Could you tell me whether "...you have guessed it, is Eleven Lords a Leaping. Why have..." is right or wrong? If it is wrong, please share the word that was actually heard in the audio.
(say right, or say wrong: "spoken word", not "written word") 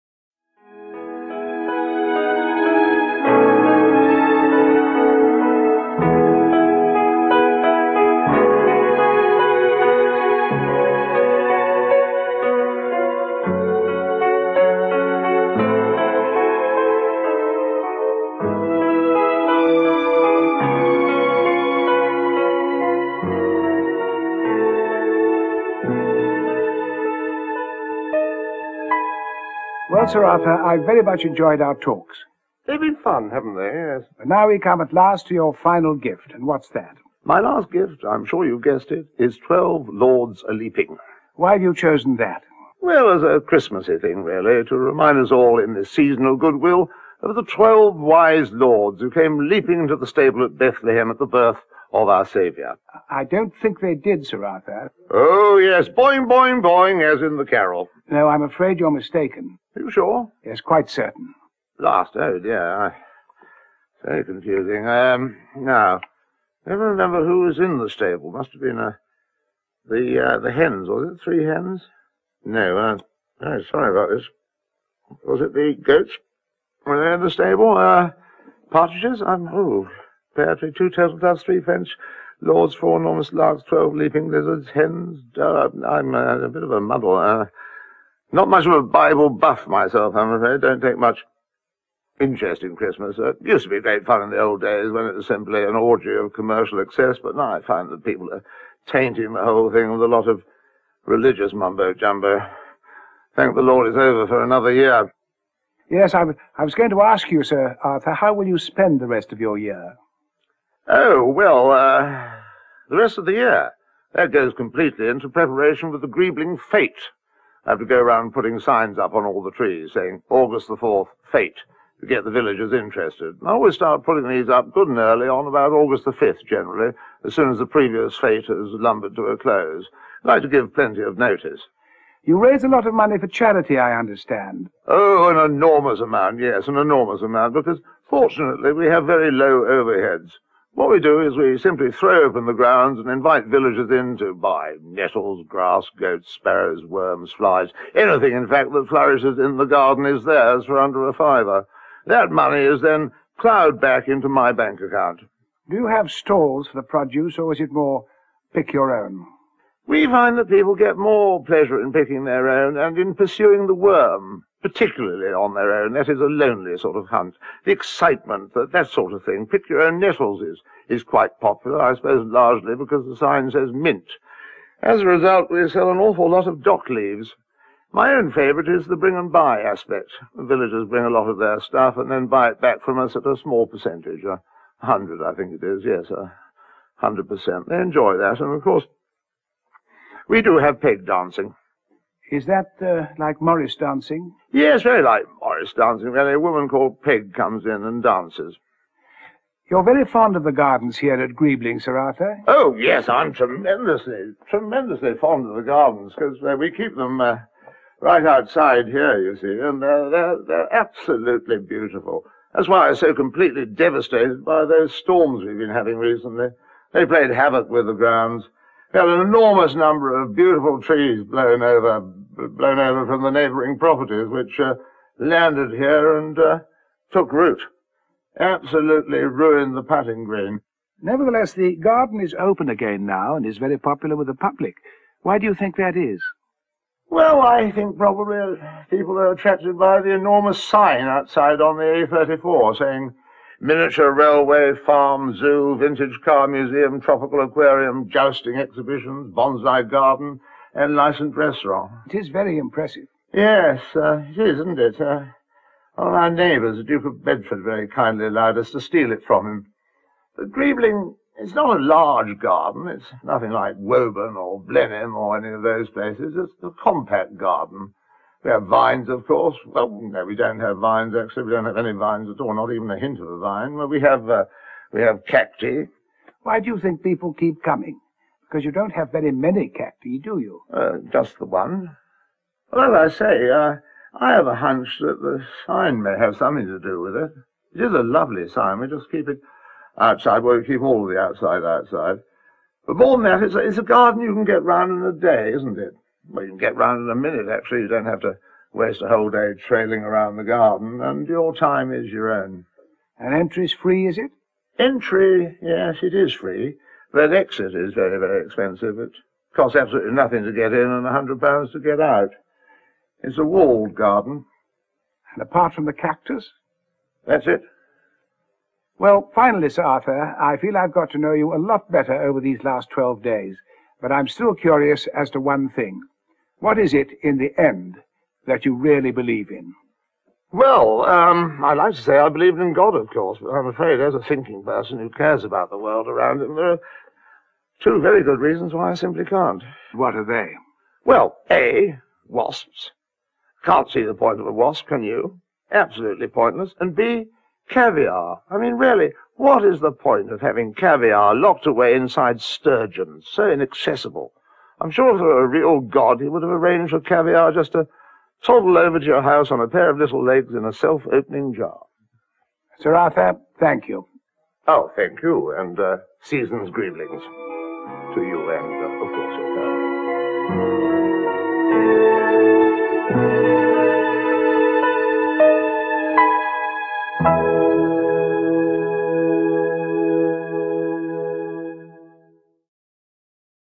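wrong: "Twelve", not "Eleven".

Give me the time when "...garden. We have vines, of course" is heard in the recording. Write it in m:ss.
4:27.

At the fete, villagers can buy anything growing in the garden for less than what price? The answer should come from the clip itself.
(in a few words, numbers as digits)
Under a fiver.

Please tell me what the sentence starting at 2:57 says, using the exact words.
My own favourite is the bring and buy aspect.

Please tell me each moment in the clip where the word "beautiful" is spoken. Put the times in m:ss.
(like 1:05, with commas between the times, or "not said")
3:31, 3:40.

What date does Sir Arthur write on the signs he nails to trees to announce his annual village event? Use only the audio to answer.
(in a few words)
August 4th.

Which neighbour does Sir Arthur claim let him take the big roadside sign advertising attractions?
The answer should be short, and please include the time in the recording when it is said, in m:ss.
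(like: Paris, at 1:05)
The Duke of Bedford, at 4:16.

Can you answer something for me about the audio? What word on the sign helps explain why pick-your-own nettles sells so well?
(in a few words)
Mint.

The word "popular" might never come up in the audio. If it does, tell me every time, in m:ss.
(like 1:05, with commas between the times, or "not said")
2:51, 3:53.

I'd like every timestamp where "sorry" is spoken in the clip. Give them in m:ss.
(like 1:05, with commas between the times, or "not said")
1:13.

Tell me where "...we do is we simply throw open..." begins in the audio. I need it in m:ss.
2:20.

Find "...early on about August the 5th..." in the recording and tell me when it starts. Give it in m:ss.
2:04.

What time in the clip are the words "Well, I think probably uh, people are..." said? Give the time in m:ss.
3:57.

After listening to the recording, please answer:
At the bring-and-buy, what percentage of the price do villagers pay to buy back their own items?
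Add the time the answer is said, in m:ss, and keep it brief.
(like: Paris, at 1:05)
100 percent, at 3:06.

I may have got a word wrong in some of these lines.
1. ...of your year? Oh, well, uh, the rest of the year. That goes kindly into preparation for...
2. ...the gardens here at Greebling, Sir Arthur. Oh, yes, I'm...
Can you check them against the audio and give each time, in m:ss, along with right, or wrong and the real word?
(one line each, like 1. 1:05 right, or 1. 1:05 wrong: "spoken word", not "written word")
1. 1:49 wrong: "completely", not "kindly"
2. 3:20 right.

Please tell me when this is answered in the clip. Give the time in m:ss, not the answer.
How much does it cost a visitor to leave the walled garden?
5:11.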